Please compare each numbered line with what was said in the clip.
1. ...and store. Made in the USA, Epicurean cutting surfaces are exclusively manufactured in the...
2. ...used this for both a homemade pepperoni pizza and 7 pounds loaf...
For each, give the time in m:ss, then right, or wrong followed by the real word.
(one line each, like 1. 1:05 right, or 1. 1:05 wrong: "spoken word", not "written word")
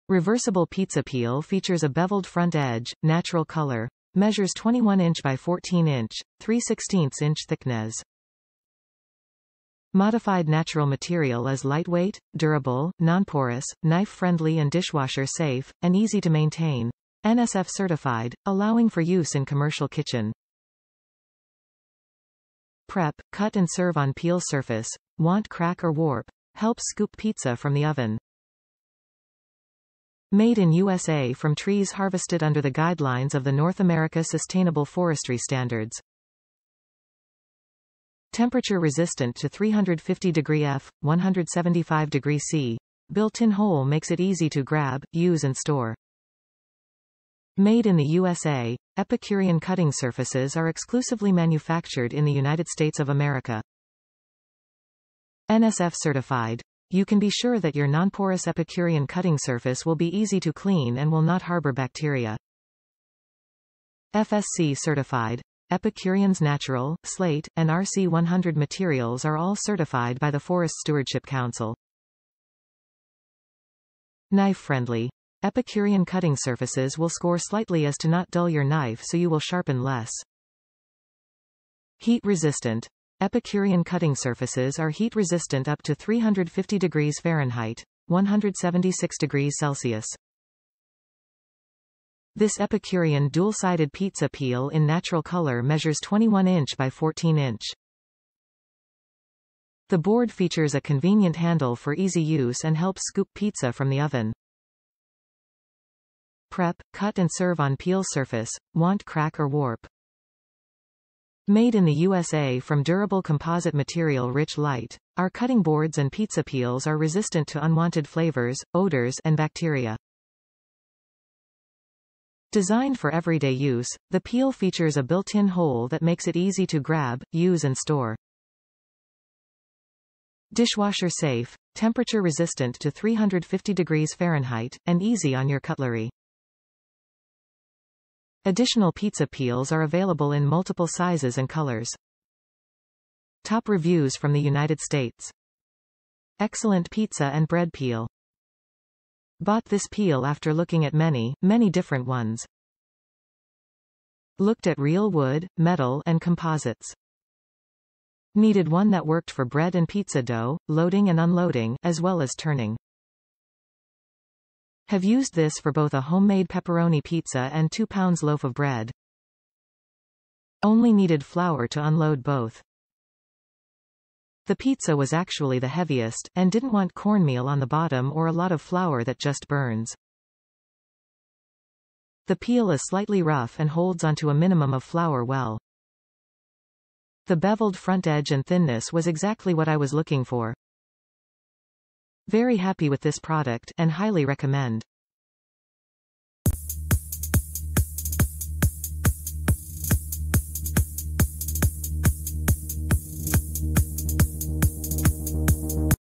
1. 0:45 right
2. 2:45 wrong: "2", not "7".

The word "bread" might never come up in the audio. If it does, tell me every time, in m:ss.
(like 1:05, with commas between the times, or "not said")
2:27, 2:39, 2:48.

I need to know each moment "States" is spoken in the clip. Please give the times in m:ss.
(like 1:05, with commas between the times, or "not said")
0:52, 2:24.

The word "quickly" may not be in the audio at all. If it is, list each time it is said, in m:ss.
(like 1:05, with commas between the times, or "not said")
not said.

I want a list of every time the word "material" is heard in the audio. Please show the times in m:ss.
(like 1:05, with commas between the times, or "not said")
0:10, 1:08, 1:53.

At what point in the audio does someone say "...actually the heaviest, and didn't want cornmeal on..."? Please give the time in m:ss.
2:55.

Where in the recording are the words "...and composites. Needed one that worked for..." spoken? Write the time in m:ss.
2:36.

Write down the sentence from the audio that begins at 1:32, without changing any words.
This Epicurean dual-sided pizza peel in natural color measures 21 inch by 14 inch.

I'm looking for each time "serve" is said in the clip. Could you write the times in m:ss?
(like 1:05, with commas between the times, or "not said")
0:23, 1:47.